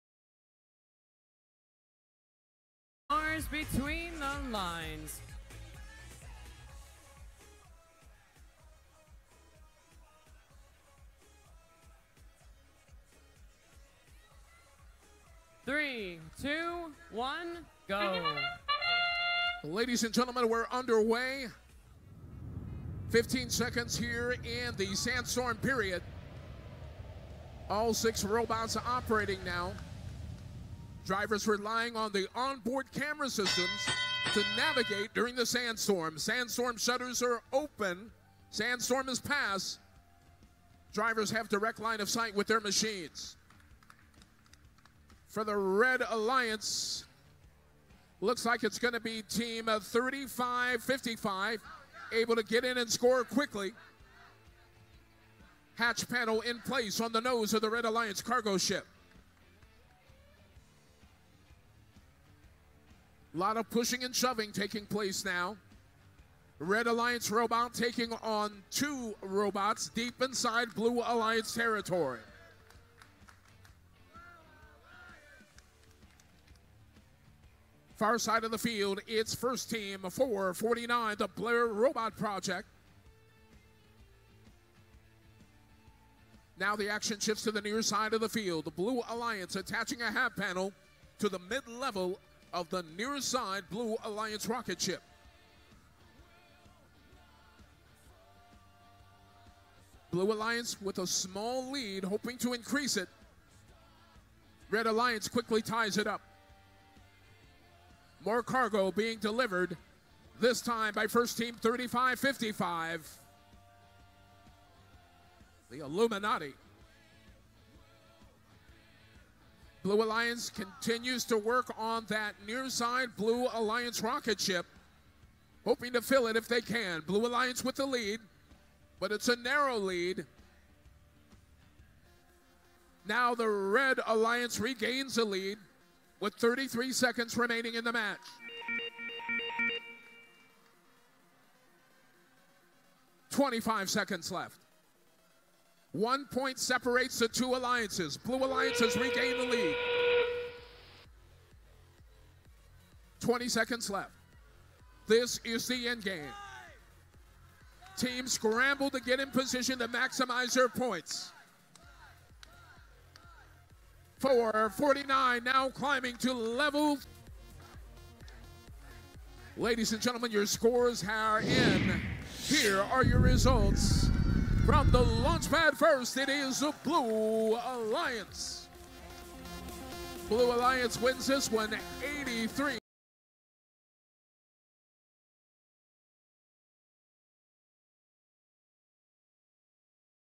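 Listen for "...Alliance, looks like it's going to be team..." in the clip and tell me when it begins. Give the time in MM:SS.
00:46.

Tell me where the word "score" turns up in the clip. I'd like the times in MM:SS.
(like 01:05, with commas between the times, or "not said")
00:52, 02:50.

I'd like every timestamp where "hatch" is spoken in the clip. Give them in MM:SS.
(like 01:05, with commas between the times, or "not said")
00:55, 01:30.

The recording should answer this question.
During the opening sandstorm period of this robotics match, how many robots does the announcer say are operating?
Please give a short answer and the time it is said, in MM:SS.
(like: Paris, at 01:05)
6, at 00:27.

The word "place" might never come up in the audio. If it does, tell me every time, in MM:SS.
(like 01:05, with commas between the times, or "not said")
00:56, 01:04.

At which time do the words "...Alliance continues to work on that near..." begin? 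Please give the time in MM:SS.
02:00.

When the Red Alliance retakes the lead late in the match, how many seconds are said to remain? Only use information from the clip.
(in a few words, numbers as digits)
33.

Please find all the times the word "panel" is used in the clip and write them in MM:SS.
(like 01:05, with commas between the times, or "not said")
00:56, 01:30.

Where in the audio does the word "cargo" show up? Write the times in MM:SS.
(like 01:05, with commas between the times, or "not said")
00:58, 01:48.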